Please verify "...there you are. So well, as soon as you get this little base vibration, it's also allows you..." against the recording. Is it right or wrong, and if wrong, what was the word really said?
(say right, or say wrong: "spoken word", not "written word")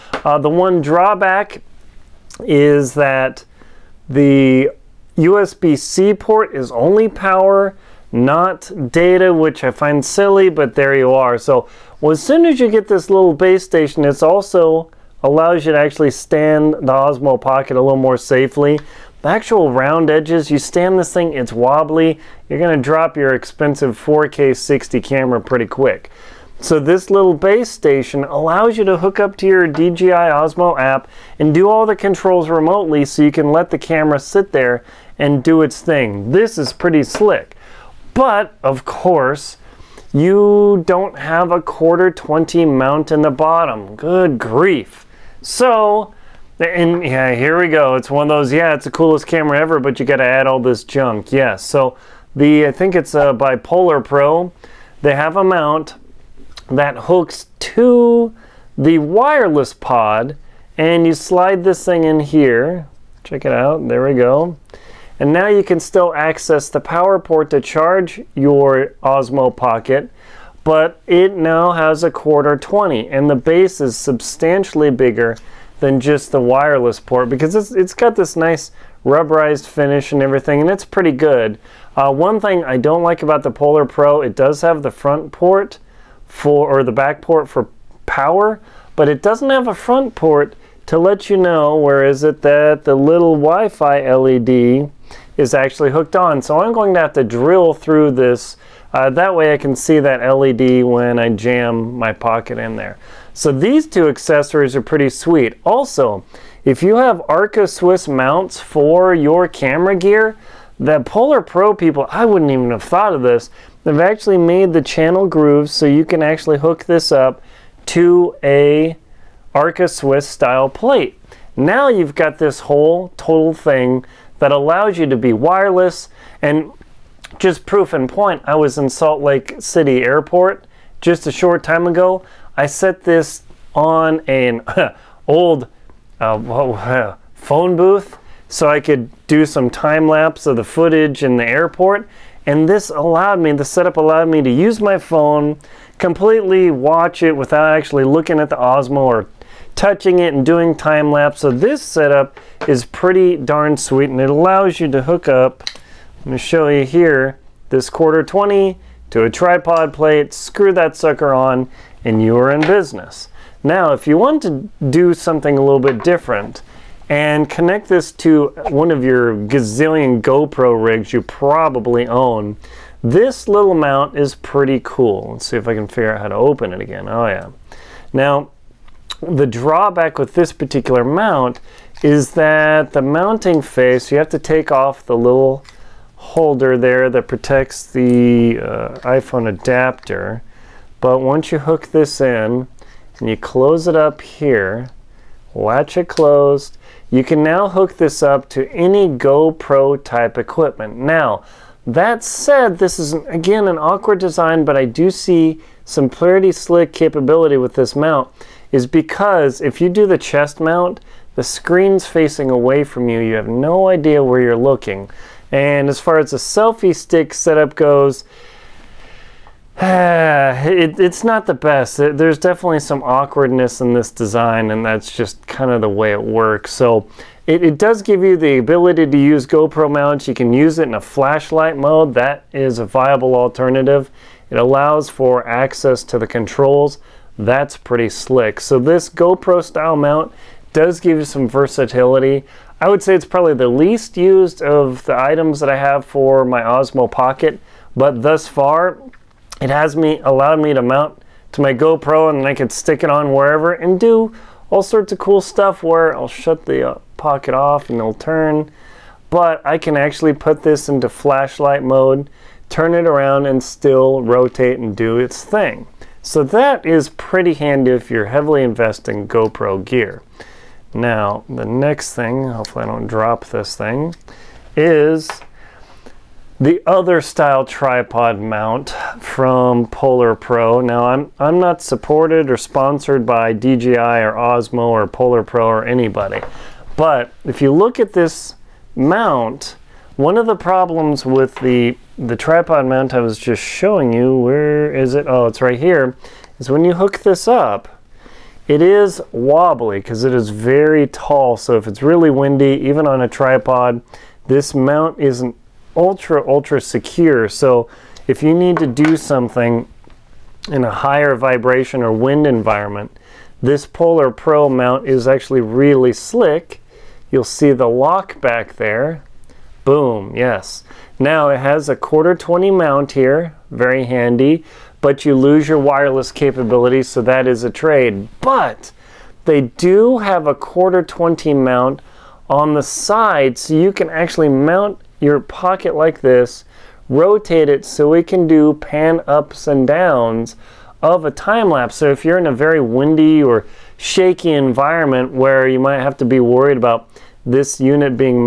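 wrong: "station", not "vibration".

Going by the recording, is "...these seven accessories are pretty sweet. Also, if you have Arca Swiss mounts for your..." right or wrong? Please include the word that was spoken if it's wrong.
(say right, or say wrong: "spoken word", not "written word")
wrong: "two", not "seven".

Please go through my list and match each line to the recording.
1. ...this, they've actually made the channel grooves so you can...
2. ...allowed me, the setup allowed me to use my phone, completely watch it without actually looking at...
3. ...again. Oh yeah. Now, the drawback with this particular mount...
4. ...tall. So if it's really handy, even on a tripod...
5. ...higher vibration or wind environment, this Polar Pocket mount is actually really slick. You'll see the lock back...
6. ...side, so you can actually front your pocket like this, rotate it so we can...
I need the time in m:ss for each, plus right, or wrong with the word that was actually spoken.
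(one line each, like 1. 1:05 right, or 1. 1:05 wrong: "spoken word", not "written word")
1. 1:53 right
2. 2:22 right
3. 2:56 right
4. 5:01 wrong: "windy", not "handy"
5. 5:10 wrong: "Pro", not "Pocket"
6. 5:32 wrong: "mount", not "front".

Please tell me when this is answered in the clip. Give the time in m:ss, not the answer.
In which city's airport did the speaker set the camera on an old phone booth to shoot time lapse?
2:08.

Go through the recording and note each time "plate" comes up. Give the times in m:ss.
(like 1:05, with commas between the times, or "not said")
2:00, 2:39.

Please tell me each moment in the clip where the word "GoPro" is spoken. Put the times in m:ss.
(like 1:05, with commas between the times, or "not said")
2:50, 3:19, 3:49, 3:59, 4:11, 4:29.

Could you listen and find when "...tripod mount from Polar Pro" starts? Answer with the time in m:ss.
4:37.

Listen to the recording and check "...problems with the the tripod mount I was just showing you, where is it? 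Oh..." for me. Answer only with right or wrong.
right.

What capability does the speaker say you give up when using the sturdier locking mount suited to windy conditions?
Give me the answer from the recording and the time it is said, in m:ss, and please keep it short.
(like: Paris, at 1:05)
wireless capability, at 5:25.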